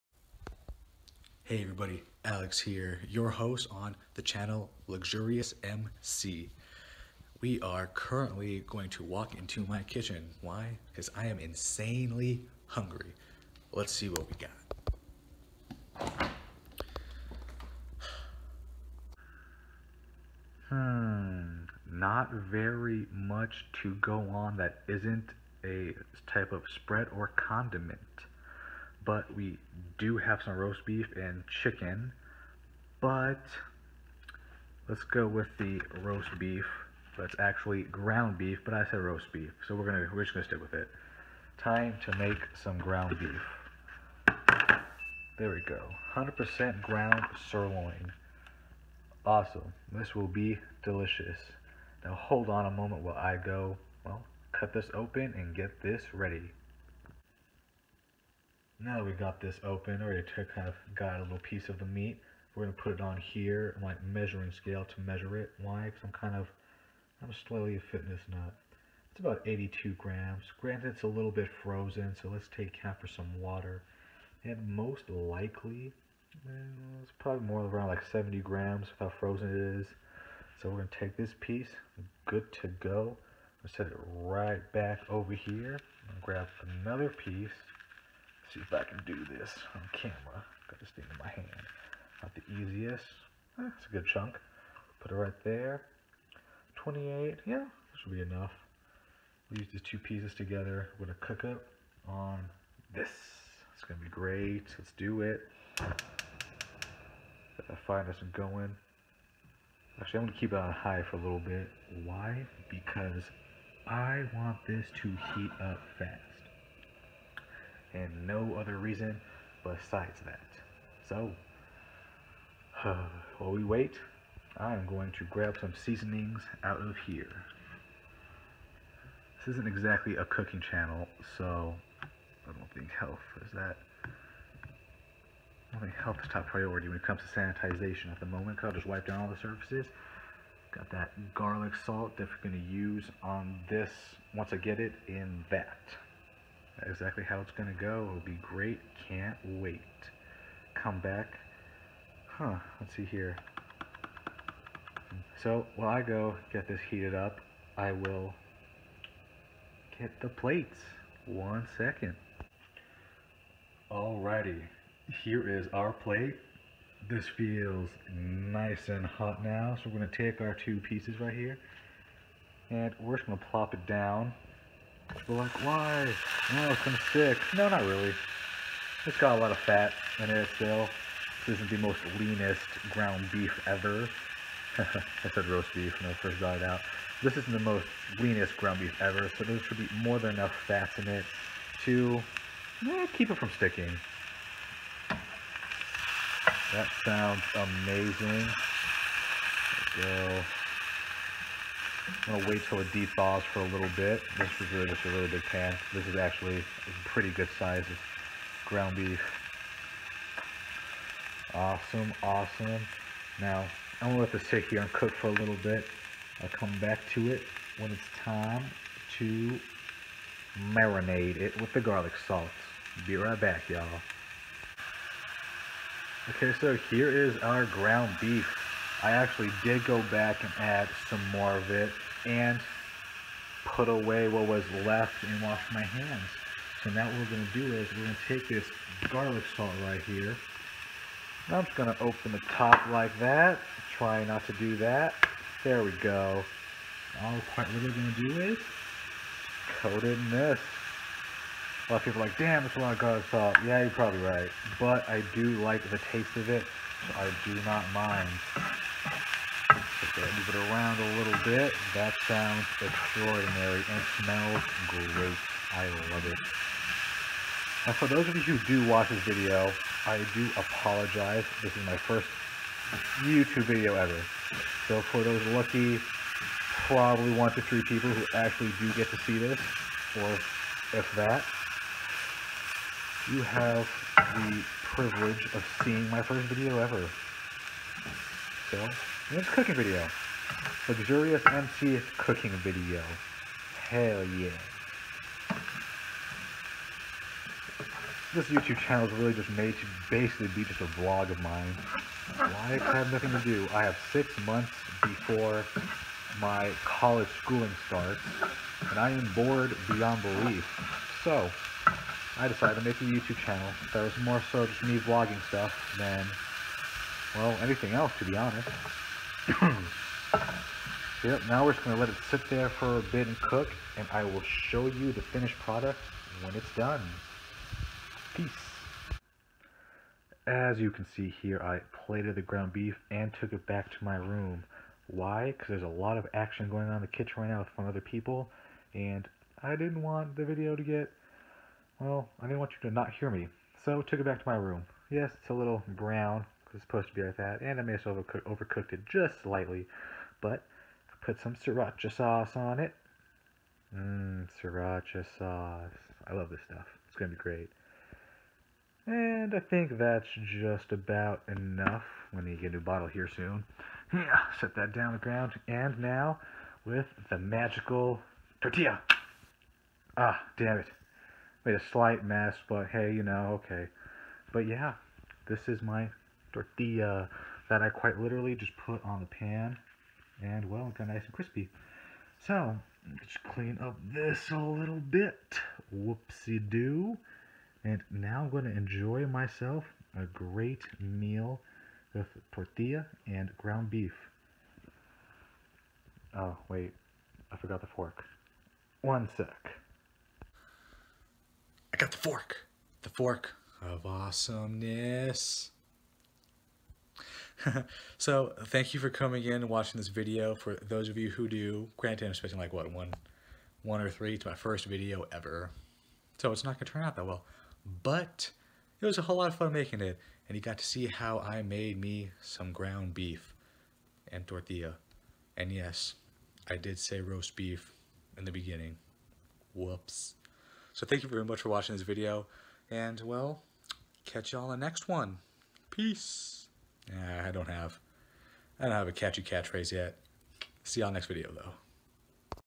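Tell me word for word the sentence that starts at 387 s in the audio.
And now I'm going to enjoy myself a great meal with tortilla and ground beef.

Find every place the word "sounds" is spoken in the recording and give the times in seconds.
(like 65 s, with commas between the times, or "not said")
197 s, 262 s.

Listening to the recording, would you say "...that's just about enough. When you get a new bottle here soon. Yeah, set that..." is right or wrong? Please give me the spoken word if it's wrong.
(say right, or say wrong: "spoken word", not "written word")
right.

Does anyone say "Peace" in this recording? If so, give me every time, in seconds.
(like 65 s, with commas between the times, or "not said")
328 s, 435 s.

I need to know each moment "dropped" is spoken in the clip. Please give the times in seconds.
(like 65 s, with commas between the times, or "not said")
not said.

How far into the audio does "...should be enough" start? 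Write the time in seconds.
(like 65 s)
98 s.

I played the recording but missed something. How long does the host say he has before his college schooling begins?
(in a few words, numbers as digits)
Six months.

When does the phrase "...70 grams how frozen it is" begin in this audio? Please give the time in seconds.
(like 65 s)
78 s.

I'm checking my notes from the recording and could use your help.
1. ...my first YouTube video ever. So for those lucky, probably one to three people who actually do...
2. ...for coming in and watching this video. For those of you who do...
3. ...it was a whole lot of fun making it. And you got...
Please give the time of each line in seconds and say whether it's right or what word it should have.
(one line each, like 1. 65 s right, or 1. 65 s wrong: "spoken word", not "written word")
1. 271 s right
2. 408 s right
3. 418 s right.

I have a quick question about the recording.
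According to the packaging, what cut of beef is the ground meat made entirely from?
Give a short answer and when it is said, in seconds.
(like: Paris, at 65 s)
Sirloin, at 46 s.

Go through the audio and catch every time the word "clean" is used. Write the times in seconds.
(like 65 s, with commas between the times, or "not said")
383 s.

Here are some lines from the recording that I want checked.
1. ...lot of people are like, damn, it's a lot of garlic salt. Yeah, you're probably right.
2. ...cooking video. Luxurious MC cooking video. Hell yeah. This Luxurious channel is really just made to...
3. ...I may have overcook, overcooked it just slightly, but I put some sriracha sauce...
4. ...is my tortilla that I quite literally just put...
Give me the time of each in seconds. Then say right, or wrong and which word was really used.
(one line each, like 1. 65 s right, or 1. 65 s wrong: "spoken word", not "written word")
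1. 251 s right
2. 289 s wrong: "YouTube", not "Luxurious"
3. 347 s right
4. 375 s right.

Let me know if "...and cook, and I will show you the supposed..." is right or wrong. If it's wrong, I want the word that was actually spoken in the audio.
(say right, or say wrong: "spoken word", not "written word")
wrong: "finished", not "supposed".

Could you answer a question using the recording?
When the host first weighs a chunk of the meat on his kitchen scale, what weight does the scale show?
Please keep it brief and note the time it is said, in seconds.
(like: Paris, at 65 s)
82 grams, at 69 s.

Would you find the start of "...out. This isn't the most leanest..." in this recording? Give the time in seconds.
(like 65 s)
186 s.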